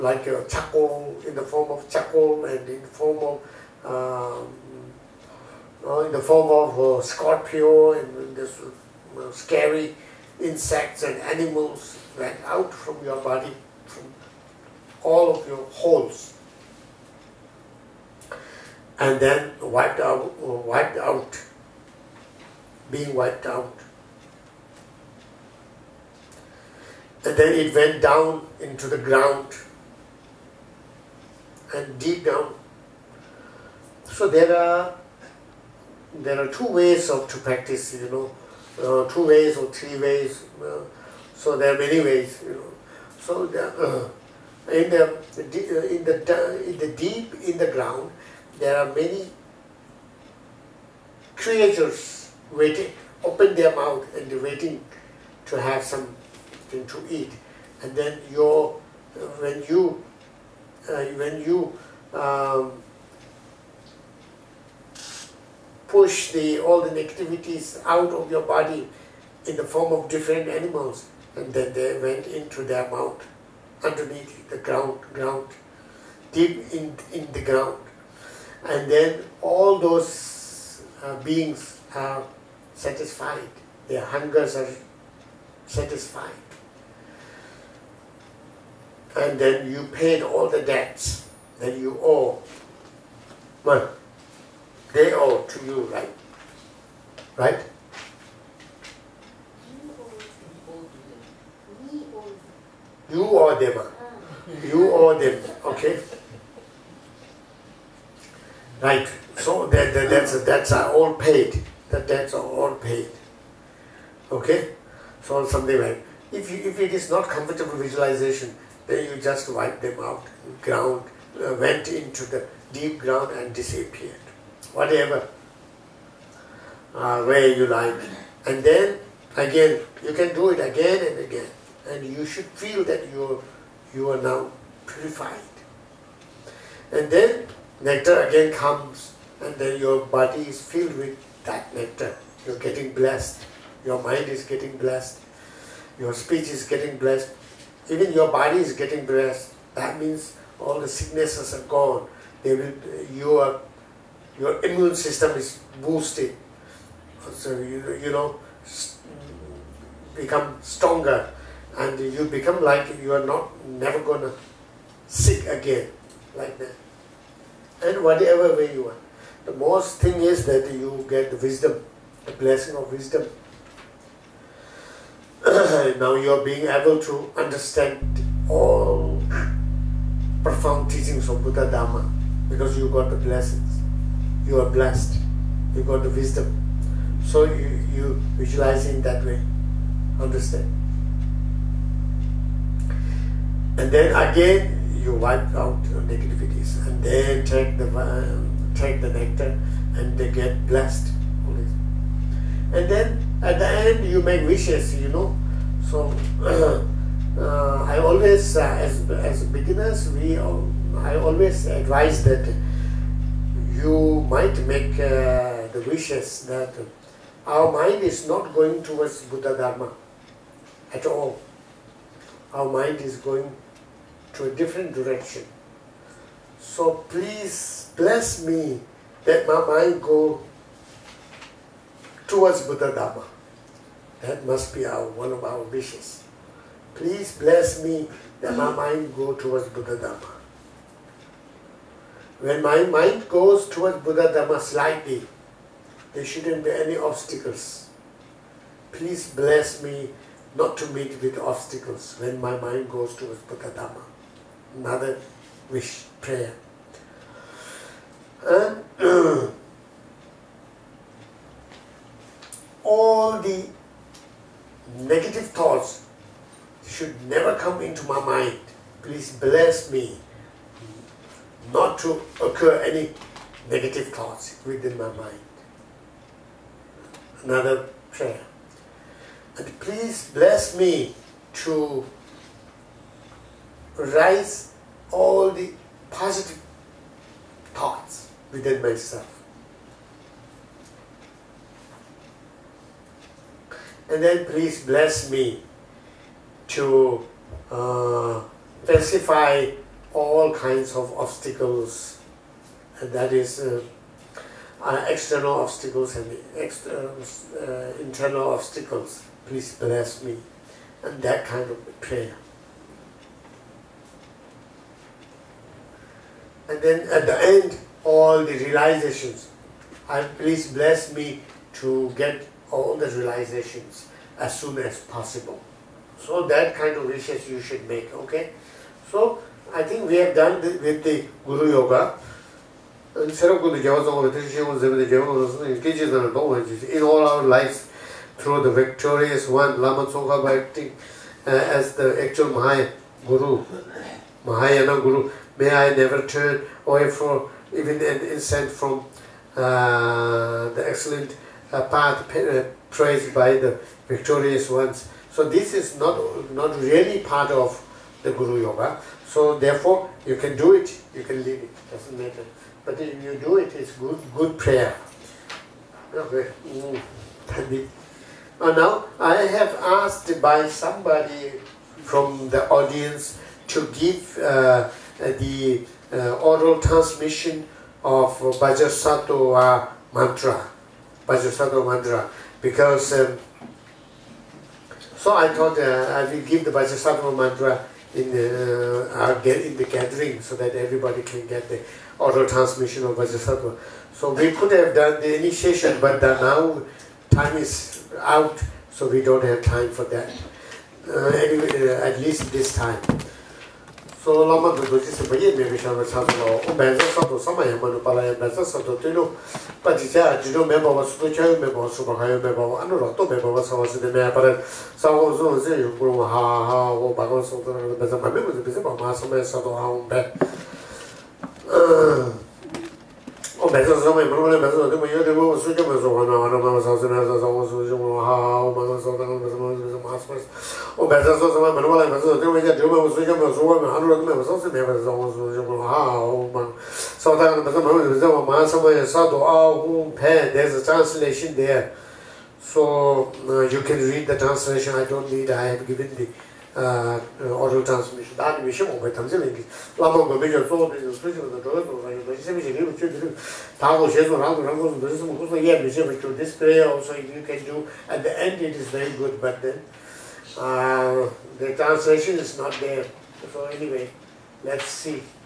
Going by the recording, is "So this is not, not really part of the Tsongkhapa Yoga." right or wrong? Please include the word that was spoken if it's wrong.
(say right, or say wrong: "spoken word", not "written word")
wrong: "Guru", not "Tsongkhapa".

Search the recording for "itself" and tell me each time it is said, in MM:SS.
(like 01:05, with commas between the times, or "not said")
not said.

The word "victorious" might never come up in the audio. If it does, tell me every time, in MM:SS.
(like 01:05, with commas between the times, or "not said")
05:38, 05:54.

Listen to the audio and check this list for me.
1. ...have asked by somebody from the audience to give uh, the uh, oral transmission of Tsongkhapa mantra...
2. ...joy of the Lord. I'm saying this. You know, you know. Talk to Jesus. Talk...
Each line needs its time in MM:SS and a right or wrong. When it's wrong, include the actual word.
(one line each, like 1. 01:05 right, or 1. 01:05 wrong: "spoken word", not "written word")
1. 06:09 wrong: "Vajrasattva", not "Tsongkhapa"
2. 07:31 right.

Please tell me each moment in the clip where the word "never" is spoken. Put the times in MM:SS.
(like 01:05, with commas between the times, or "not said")
02:43, 04:27, 05:45.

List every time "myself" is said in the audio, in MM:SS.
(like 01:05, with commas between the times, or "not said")
04:48.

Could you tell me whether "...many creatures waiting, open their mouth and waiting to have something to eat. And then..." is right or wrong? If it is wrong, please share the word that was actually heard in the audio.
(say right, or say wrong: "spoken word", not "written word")
right.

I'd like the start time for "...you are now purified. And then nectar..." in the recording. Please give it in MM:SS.
02:13.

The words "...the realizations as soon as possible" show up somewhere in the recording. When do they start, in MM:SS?
05:22.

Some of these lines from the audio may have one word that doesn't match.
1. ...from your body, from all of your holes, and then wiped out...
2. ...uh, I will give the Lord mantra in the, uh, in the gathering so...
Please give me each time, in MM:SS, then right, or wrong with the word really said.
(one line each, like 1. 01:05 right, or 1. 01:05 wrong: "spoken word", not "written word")
1. 00:12 right
2. 06:25 wrong: "Vajrasattva", not "Lord".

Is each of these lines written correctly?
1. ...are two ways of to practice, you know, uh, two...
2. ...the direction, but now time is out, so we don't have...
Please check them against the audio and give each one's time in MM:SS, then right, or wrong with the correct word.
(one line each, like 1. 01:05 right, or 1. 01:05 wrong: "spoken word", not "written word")
1. 00:36 right
2. 06:35 wrong: "initiation", not "direction".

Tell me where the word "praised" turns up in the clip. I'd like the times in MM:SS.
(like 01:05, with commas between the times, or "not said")
05:52.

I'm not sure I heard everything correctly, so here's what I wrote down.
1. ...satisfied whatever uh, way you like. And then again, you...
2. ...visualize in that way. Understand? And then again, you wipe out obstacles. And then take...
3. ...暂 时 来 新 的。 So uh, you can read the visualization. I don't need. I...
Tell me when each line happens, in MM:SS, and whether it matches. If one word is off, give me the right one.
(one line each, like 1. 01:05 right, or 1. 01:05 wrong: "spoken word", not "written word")
1. 02:03 wrong: "disappeared", not "satisfied"
2. 03:08 wrong: "negativities", not "obstacles"
3. 07:20 wrong: "translation", not "visualization".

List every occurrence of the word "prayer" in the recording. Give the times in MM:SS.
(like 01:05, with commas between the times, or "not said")
04:16, 04:38, 05:11, 06:04.